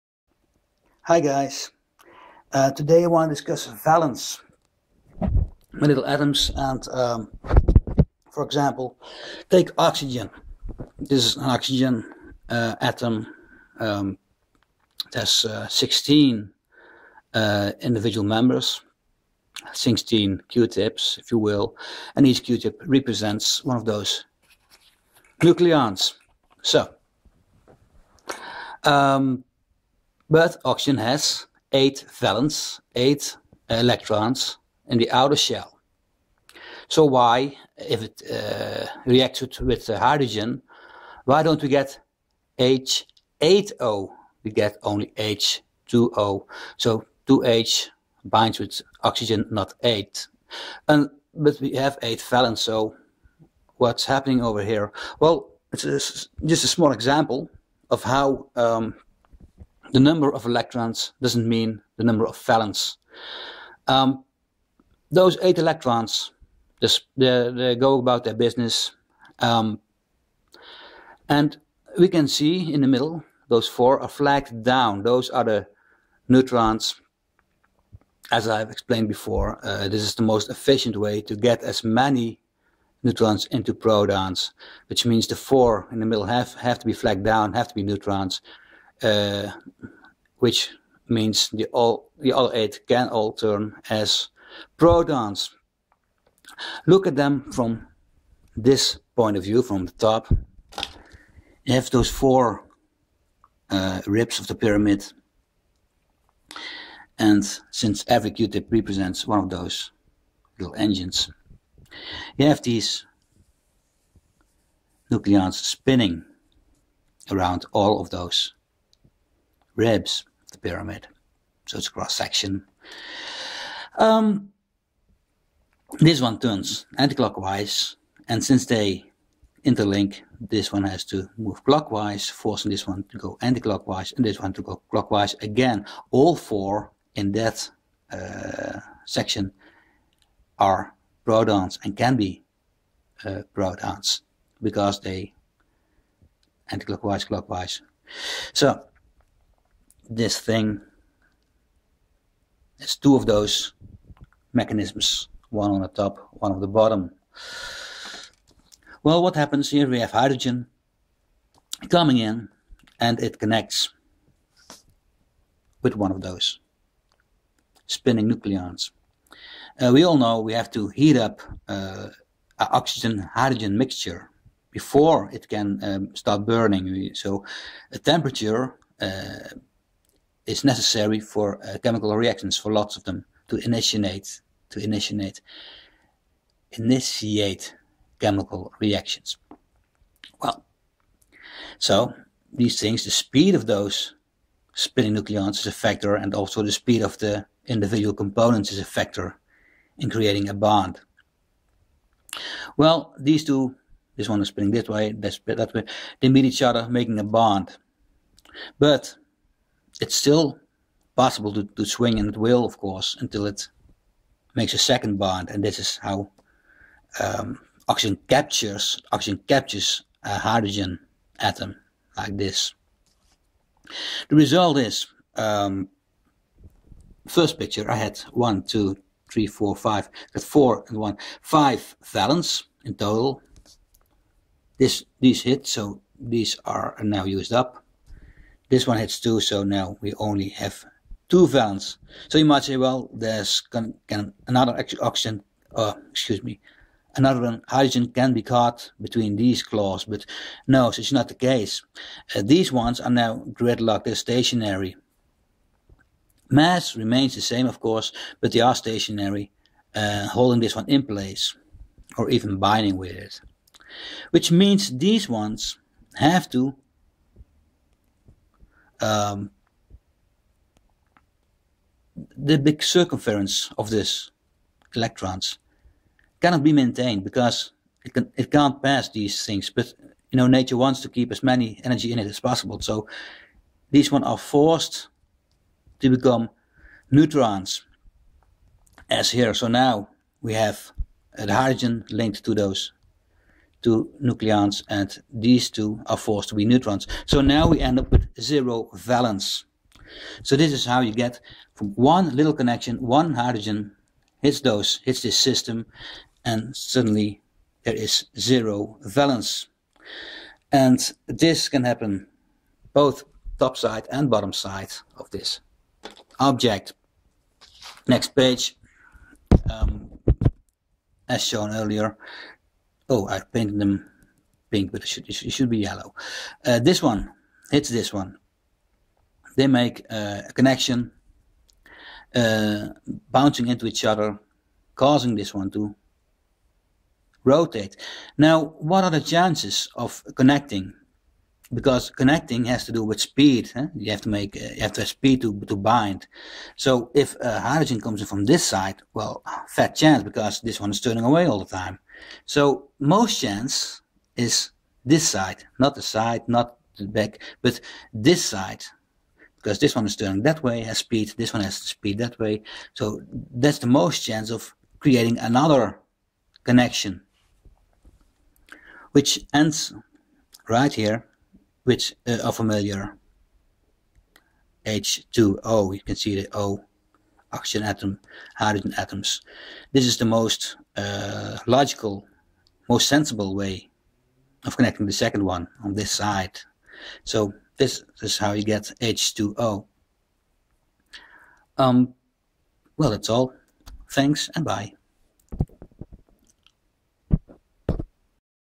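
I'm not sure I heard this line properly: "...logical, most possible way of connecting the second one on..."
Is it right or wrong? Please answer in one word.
wrong.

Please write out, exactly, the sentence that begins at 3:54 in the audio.
This these hit, so these are now used up.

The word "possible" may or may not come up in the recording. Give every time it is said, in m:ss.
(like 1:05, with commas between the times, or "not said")
3:31, 4:42.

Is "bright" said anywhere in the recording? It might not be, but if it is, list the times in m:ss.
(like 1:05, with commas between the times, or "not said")
not said.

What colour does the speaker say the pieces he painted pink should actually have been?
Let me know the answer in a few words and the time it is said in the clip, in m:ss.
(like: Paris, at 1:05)
yellow, at 5:25.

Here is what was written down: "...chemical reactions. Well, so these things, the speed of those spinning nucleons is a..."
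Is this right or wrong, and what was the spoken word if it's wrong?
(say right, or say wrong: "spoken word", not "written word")
right.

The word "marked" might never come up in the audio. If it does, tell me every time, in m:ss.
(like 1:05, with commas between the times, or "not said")
not said.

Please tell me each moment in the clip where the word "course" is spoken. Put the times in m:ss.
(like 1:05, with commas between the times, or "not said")
3:32, 4:17.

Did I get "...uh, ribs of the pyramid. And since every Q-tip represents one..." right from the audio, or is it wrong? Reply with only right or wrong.
right.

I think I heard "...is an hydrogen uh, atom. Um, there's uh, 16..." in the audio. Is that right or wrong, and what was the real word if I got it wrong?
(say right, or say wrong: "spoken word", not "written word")
wrong: "oxygen", not "hydrogen".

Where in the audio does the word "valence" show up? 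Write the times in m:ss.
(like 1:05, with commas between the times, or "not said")
0:03, 0:32, 0:52, 1:02, 3:52, 4:01, 4:58, 5:09.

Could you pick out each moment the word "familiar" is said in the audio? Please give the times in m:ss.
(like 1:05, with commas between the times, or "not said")
6:12.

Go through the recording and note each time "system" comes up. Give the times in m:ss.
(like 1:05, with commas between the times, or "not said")
5:05.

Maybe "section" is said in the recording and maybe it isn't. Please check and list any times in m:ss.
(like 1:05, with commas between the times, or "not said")
2:02, 2:19.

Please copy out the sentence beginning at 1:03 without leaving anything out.
Um, those eight electrons, this, they, they, go about their business.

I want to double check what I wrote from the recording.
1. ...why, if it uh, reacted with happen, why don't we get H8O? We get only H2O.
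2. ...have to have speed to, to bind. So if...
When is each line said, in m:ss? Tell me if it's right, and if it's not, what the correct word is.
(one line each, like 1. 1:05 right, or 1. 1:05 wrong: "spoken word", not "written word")
1. 0:37 wrong: "hydrogen", not "happen"
2. 5:44 right.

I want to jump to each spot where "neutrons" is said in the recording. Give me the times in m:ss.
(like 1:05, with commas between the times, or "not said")
1:16, 1:23, 1:27, 4:47, 4:56.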